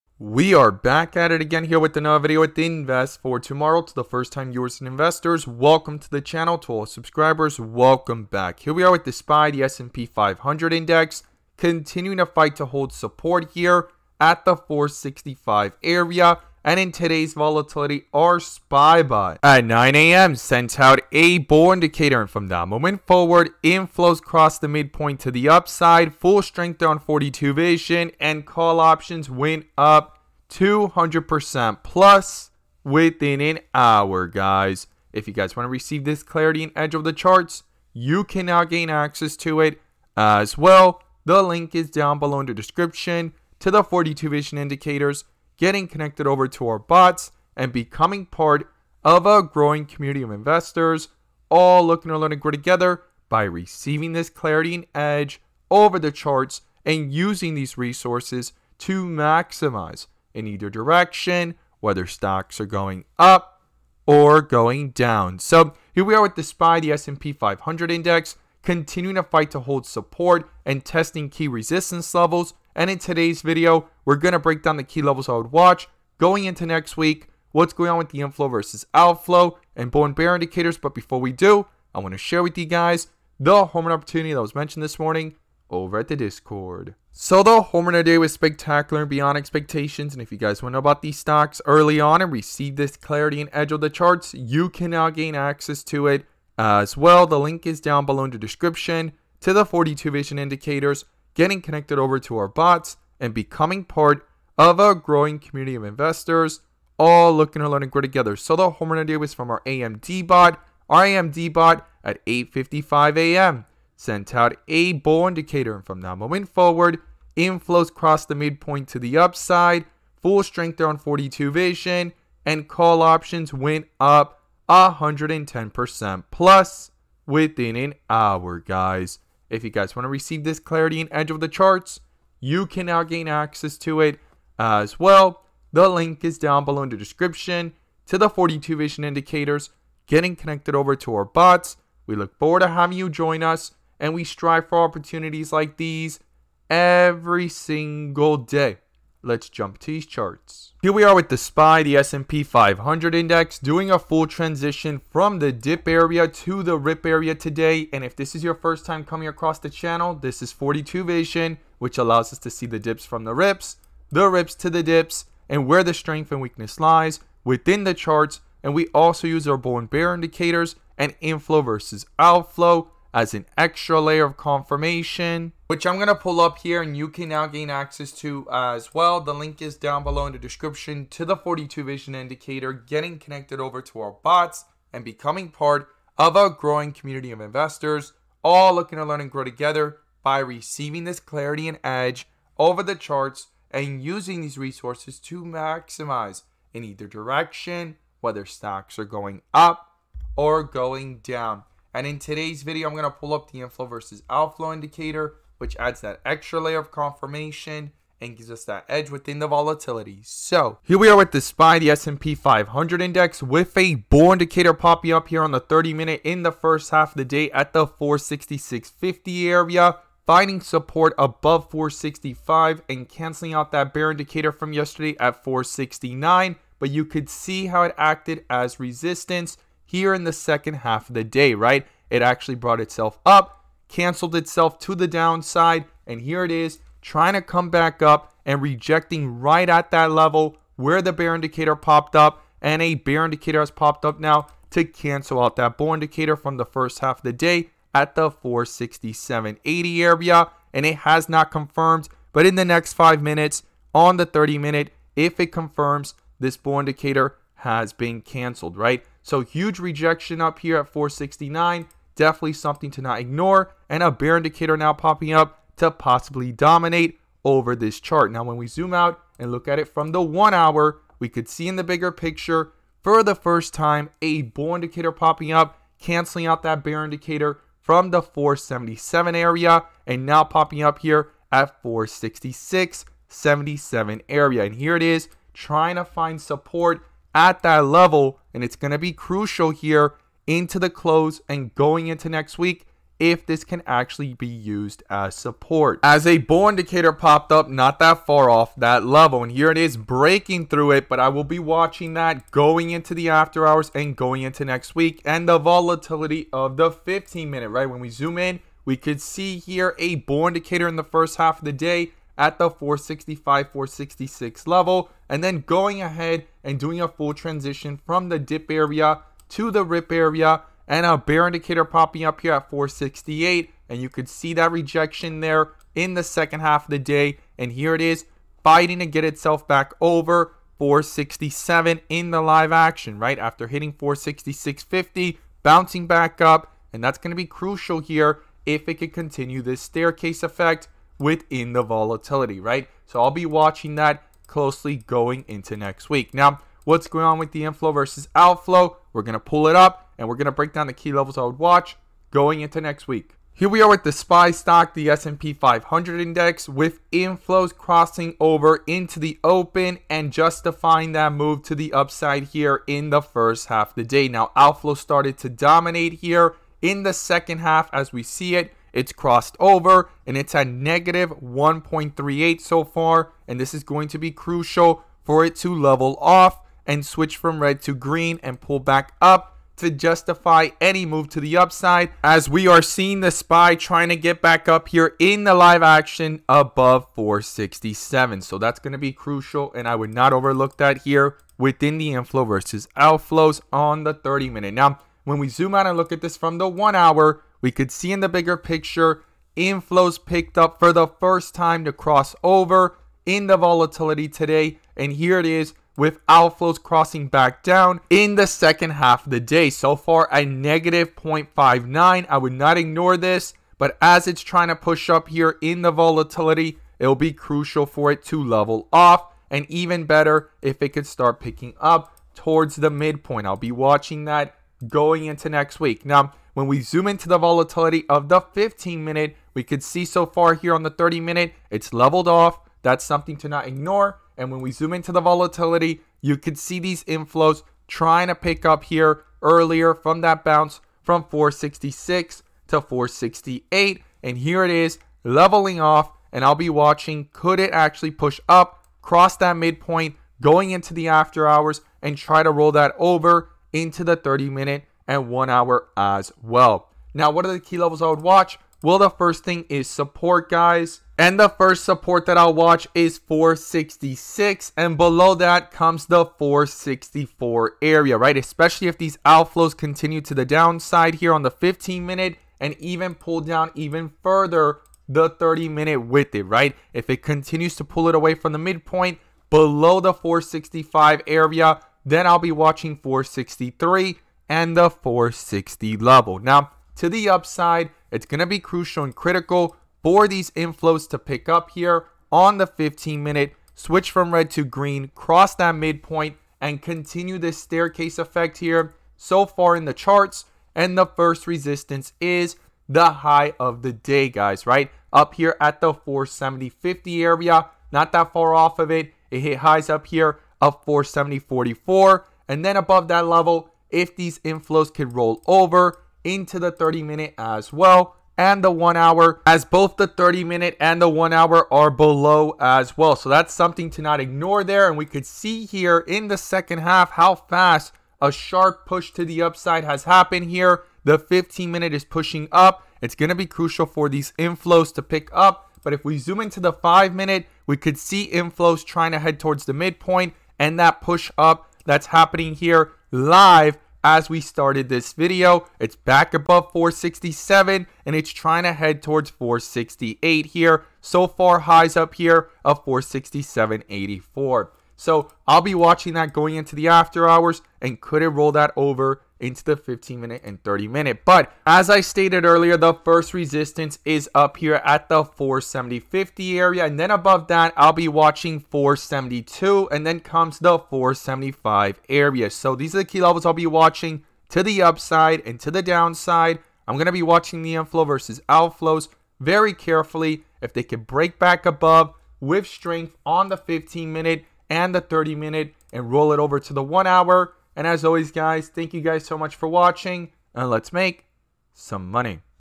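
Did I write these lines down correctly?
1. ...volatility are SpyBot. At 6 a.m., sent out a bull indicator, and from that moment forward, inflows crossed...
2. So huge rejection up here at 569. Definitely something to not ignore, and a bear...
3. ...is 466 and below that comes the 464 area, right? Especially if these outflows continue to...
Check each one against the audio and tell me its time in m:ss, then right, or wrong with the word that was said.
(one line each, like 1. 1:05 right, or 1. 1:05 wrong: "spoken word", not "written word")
1. 0:17 wrong: "9", not "6"
2. 4:19 wrong: "469", not "569"
3. 7:42 right.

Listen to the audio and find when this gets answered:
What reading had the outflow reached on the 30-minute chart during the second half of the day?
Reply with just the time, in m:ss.
6:10.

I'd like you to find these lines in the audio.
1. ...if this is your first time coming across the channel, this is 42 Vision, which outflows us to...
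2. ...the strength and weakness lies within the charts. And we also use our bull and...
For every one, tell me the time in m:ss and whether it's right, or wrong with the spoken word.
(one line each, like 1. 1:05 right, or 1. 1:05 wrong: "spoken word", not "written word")
1. 2:38 wrong: "allows", not "outflows"
2. 2:45 right.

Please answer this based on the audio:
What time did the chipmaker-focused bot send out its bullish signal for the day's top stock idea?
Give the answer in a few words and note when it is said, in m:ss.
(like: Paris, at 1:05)
8:55 a.m., at 1:52.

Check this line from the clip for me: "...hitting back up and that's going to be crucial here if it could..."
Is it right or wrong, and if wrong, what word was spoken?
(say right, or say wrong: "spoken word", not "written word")
wrong: "bouncing", not "hitting".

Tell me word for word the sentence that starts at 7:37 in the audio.
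Now, what are the key levels I would watch?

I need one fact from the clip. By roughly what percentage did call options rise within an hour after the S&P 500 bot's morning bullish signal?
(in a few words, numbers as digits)
200%.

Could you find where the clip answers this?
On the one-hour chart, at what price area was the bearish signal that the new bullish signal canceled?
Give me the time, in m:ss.
4:38.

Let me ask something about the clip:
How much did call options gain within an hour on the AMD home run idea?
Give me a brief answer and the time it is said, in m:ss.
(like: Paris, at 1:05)
110%, at 2:04.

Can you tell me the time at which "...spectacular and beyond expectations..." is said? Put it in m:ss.
1:28.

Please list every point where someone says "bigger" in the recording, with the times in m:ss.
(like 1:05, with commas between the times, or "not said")
4:31, 6:38.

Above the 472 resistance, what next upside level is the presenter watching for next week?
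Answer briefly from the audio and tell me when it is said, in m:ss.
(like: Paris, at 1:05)
475, at 9:30.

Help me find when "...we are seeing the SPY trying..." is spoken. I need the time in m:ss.
6:22.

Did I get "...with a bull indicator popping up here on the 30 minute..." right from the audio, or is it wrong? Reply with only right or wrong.
right.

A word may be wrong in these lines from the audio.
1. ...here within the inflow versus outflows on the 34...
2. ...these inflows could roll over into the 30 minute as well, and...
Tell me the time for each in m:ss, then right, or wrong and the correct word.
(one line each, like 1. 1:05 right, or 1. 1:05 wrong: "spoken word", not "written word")
1. 6:30 wrong: "30", not "34"
2. 8:34 right.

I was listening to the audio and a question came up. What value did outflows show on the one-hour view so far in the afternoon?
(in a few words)
-0.59.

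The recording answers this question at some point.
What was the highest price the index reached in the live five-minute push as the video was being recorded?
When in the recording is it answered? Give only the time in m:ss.
9:12.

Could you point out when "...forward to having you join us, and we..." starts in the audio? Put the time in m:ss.
2:22.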